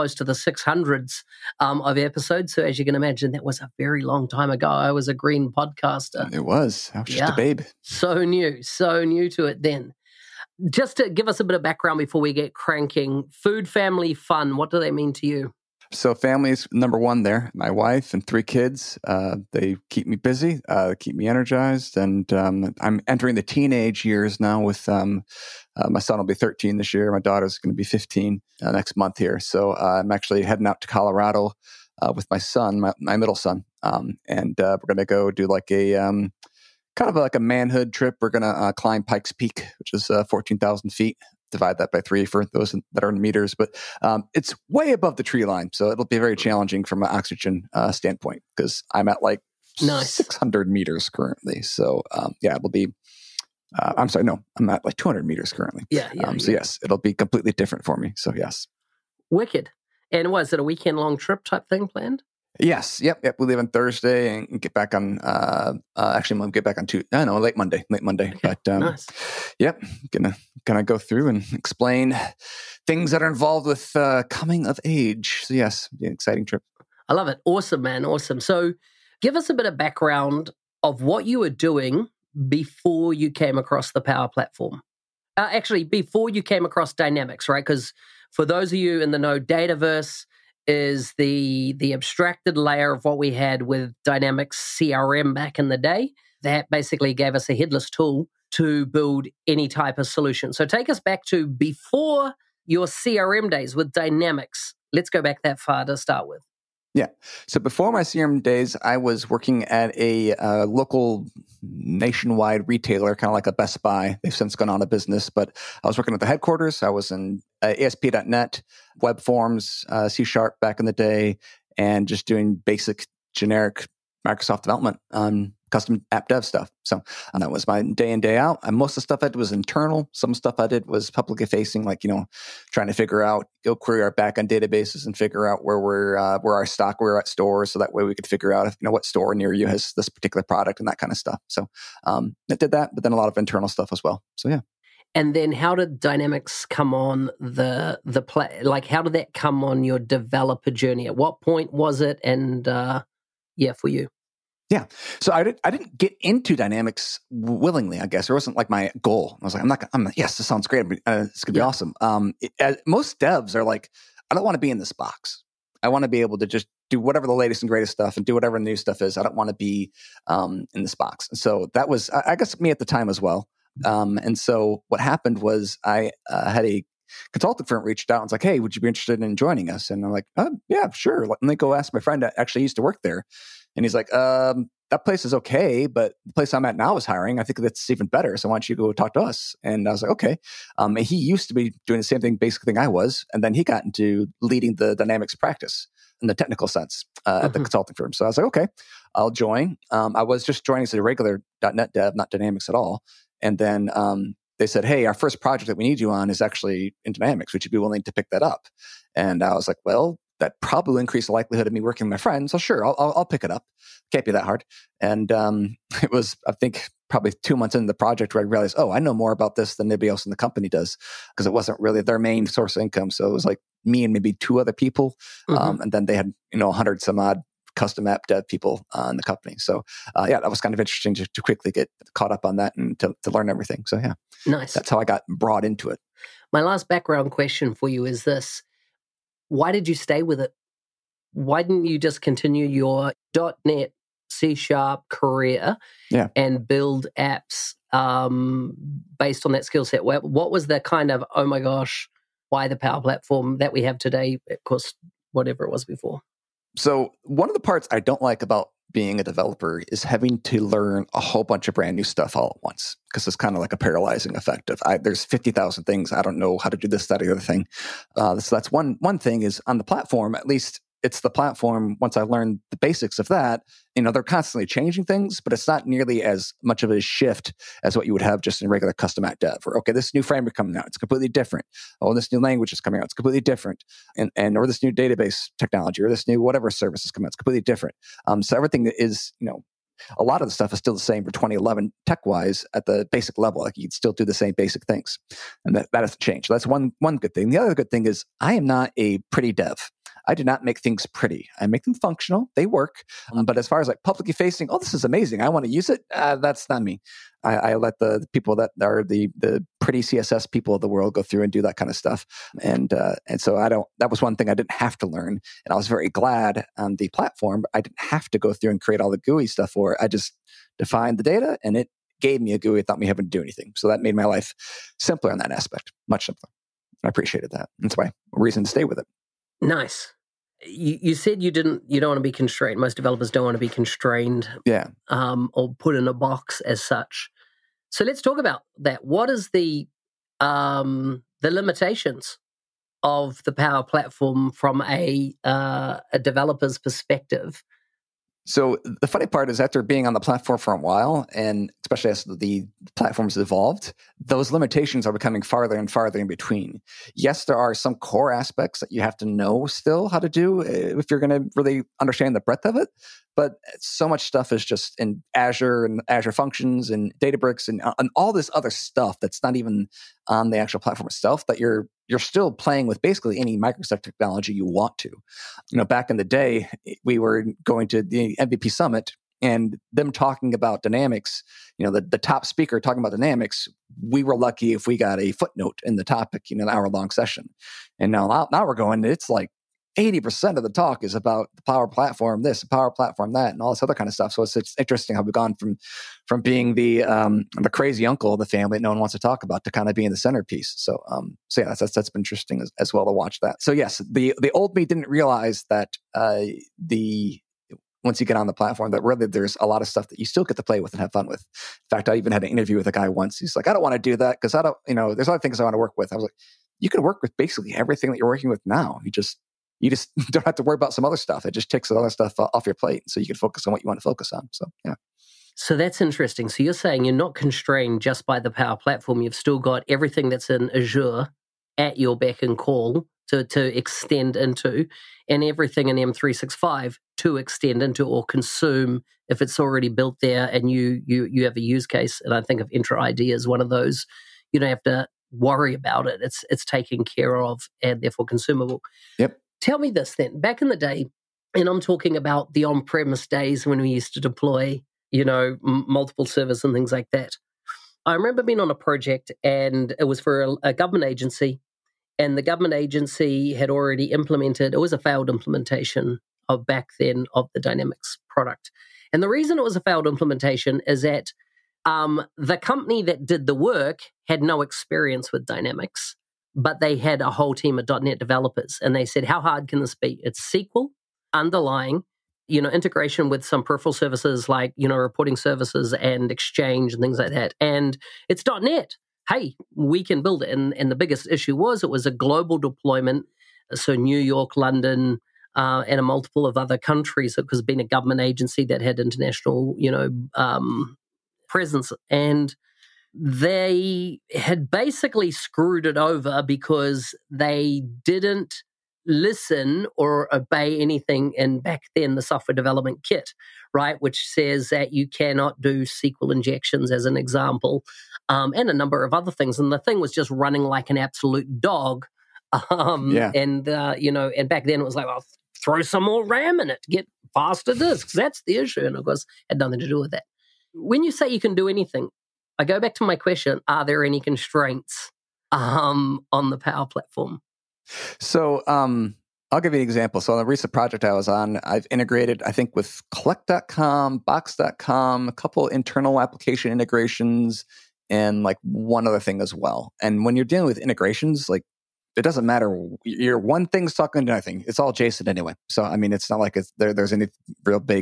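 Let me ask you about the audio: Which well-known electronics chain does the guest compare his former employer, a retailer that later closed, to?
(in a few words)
Best Buy.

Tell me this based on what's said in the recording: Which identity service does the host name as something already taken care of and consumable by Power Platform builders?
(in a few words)
Entra ID.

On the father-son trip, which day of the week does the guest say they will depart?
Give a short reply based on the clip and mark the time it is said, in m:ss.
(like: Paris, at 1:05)
Thursday, at 1:03.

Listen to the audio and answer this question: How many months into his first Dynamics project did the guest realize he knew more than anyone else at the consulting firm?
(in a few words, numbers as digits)
2.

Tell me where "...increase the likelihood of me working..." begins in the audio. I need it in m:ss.
3:30.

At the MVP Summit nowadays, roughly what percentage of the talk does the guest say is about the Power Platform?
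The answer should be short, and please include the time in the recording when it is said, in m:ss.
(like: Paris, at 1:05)
80%, at 6:29.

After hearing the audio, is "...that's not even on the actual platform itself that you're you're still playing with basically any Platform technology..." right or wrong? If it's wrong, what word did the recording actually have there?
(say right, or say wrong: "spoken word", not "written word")
wrong: "Microsoft", not "Platform".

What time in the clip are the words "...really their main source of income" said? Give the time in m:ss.
3:41.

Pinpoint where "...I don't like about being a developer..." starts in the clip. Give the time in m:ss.
4:17.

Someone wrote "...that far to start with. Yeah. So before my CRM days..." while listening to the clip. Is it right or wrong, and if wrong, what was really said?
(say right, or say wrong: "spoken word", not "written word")
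right.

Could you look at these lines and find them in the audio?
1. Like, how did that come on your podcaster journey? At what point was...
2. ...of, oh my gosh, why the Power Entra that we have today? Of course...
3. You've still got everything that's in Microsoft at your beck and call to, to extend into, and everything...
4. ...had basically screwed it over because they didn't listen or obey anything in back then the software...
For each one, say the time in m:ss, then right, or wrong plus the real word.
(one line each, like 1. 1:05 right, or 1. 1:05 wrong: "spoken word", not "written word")
1. 2:28 wrong: "developer", not "podcaster"
2. 4:11 wrong: "Platform", not "Entra"
3. 7:09 wrong: "Azure", not "Microsoft"
4. 8:24 right.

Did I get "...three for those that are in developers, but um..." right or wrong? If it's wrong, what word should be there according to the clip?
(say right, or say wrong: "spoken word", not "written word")
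wrong: "meters", not "developers".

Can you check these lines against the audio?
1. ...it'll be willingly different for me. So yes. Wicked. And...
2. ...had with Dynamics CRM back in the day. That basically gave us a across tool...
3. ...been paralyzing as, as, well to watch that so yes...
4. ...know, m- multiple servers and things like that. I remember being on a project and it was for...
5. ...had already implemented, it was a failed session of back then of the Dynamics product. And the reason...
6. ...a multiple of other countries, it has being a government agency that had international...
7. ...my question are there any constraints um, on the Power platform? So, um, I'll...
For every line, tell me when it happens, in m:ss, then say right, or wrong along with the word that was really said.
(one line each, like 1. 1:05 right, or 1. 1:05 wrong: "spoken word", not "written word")
1. 0:56 wrong: "completely", not "willingly"
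2. 1:33 wrong: "headless", not "across"
3. 6:42 wrong: "interesting", not "paralyzing"
4. 7:35 right
5. 7:43 wrong: "implementation", not "session"
6. 8:15 right
7. 8:53 right.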